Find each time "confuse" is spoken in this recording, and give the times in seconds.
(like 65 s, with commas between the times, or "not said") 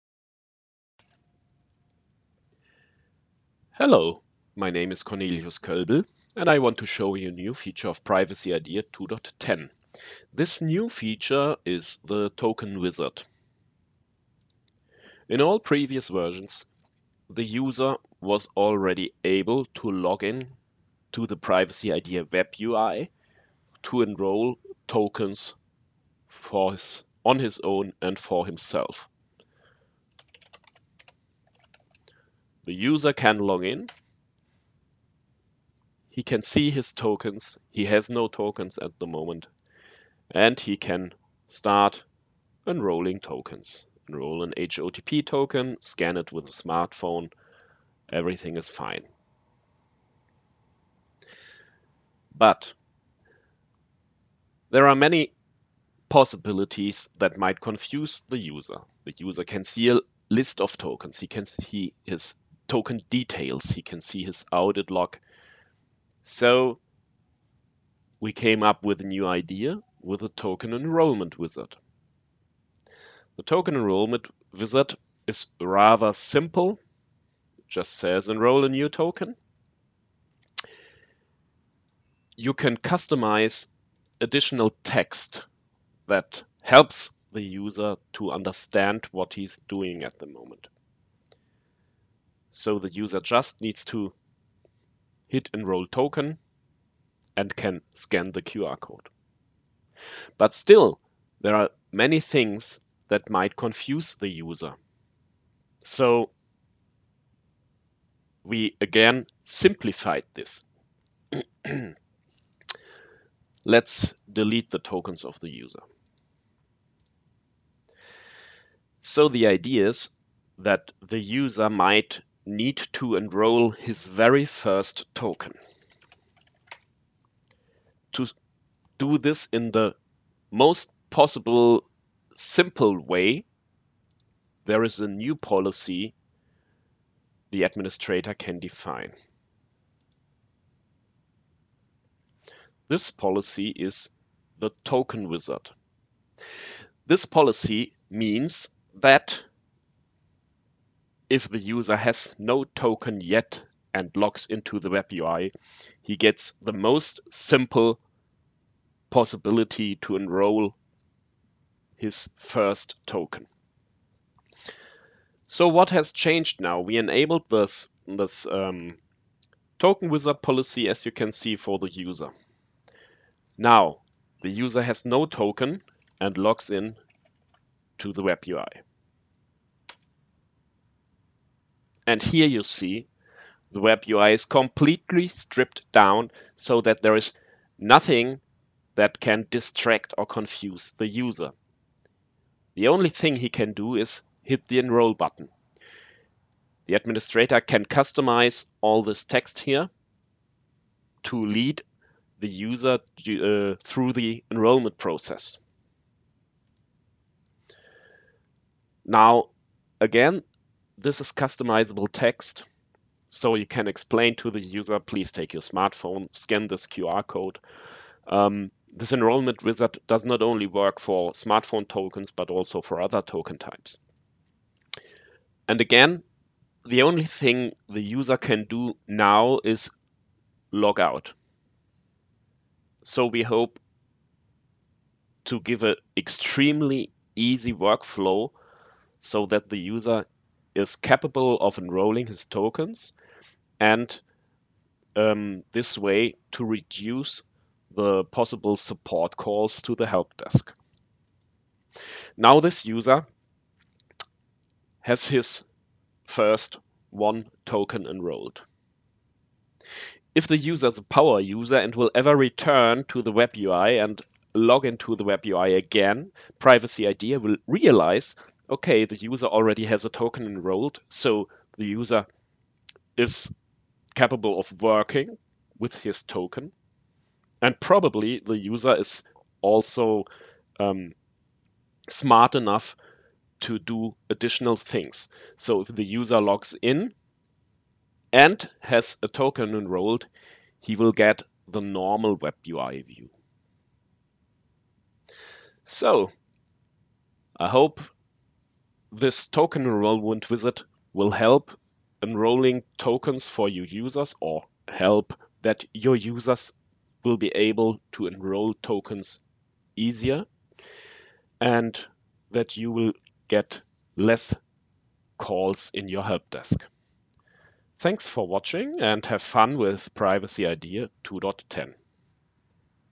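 57 s, 103 s, 190 s.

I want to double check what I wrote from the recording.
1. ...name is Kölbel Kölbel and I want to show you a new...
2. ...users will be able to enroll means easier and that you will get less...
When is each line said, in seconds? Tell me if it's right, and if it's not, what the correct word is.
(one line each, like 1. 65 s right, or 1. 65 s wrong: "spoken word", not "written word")
1. 4 s wrong: "Cornelius", not "Kölbel"
2. 306 s wrong: "tokens", not "means".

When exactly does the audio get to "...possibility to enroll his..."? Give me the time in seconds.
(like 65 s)
159 s.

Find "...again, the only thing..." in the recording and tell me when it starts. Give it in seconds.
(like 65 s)
225 s.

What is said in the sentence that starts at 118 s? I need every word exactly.
So the idea is that the user might need to enroll his very first token.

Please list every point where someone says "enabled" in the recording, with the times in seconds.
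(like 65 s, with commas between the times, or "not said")
166 s.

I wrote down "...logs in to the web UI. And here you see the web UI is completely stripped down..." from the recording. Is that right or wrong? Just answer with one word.
right.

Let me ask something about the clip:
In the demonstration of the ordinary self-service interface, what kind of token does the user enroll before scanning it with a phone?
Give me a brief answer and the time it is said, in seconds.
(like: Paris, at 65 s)
HOTP token, at 44 s.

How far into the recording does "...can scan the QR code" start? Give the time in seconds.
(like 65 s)
97 s.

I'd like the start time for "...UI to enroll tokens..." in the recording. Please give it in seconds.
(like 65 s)
22 s.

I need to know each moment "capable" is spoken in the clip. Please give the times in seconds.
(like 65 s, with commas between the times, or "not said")
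240 s, 274 s.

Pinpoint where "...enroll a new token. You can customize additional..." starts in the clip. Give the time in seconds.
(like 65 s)
78 s.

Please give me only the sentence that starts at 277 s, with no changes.
And probably the user is also um, smart enough to do additional things.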